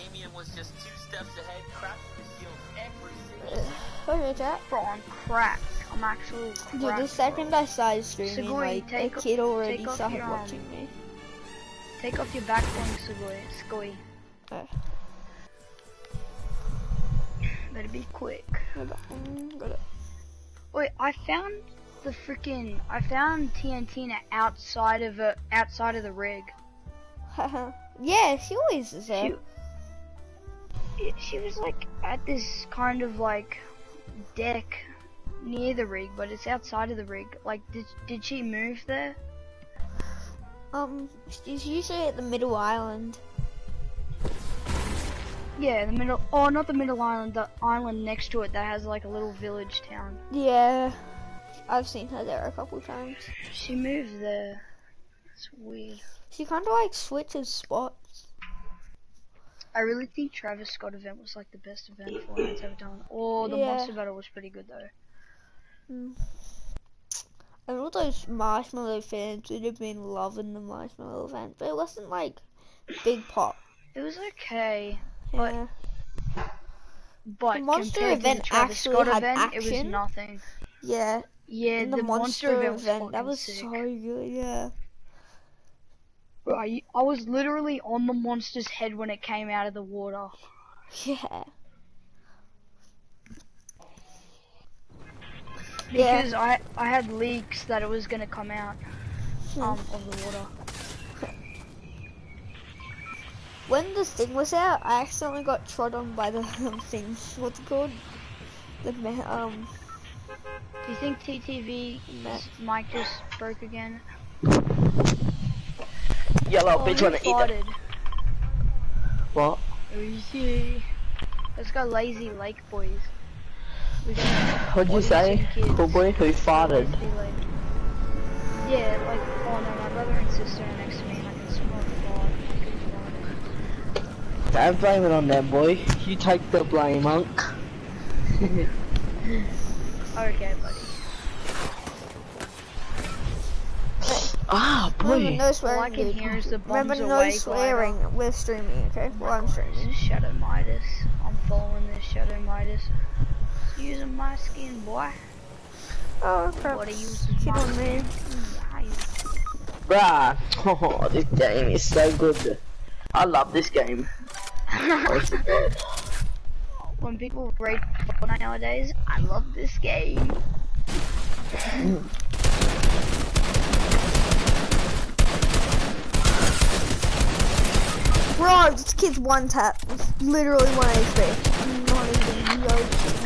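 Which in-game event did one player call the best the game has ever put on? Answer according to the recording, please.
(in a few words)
Travis Scott event.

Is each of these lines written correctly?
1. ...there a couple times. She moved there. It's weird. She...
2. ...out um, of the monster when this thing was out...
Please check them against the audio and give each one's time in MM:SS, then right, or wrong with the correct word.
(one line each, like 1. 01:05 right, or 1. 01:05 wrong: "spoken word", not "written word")
1. 00:52 right
2. 01:38 wrong: "water", not "monster".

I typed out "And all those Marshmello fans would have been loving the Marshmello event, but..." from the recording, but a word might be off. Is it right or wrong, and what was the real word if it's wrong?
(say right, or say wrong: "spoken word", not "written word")
right.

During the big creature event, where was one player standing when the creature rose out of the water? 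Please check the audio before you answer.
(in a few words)
On the monster's head.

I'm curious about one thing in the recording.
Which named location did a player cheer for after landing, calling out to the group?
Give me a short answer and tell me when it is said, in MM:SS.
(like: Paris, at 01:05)
Lazy Lake, at 02:01.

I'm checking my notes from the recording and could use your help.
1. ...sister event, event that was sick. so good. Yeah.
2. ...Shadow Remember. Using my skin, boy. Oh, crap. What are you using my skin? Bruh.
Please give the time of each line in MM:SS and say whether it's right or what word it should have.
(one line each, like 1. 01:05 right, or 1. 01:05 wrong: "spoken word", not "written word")
1. 01:22 wrong: "monster", not "sister"
2. 02:32 wrong: "Midas", not "Remember".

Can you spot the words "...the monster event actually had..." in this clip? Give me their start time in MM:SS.
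01:17.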